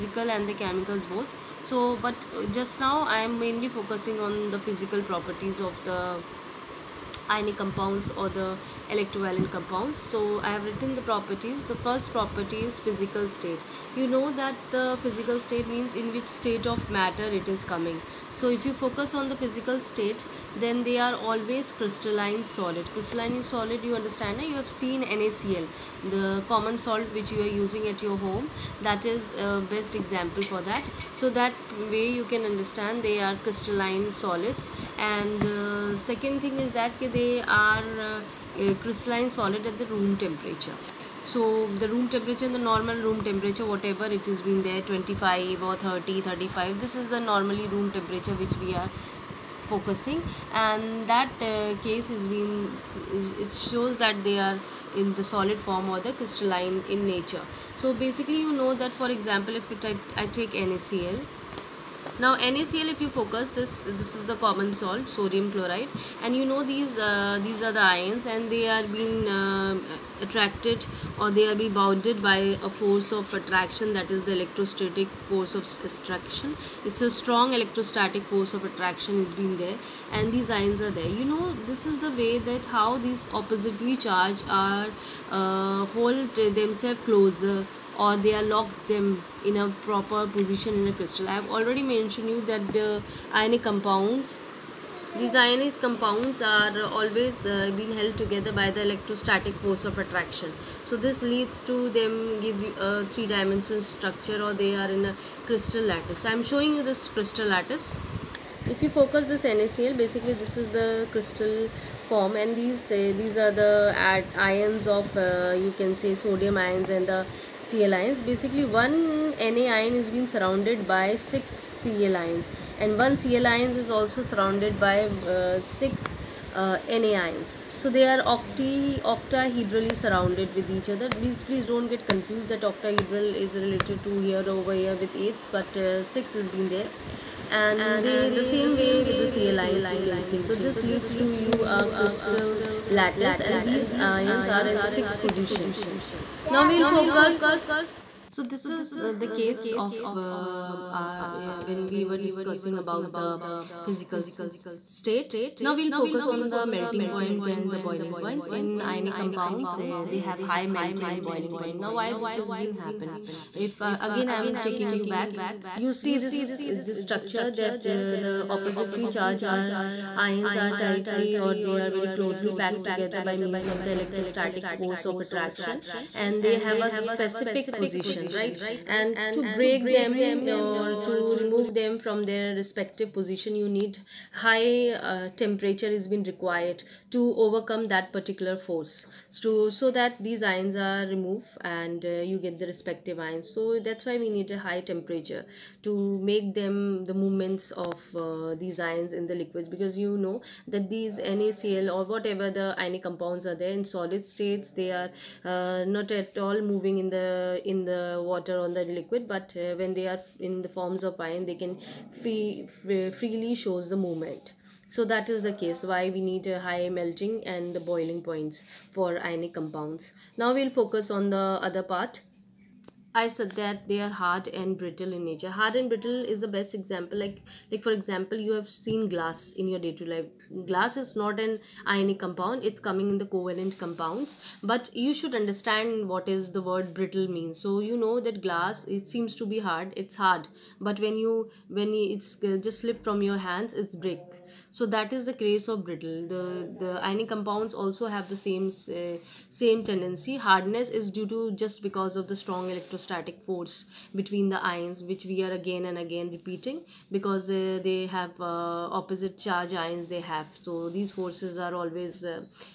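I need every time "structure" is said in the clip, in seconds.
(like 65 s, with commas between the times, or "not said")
103 s, 167 s.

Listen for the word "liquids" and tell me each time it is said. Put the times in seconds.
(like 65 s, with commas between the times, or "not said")
199 s, 208 s.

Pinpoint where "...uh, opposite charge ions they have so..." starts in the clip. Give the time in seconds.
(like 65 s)
258 s.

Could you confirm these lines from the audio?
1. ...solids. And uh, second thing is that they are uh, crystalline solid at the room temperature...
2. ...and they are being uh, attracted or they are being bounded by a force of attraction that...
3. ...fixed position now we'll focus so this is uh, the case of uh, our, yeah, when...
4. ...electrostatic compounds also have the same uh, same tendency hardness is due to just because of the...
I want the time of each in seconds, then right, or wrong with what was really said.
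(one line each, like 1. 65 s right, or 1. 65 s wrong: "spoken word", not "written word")
1. 34 s right
2. 68 s right
3. 144 s right
4. 247 s wrong: "ionic", not "electrostatic".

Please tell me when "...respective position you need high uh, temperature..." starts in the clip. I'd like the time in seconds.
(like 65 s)
182 s.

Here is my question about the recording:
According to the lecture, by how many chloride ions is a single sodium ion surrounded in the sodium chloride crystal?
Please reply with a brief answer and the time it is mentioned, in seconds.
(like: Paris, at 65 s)
6, at 121 s.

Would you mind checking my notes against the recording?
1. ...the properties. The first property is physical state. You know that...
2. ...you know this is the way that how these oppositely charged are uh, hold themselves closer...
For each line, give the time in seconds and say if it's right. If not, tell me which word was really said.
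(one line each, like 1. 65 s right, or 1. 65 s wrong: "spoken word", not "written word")
1. 10 s right
2. 81 s right.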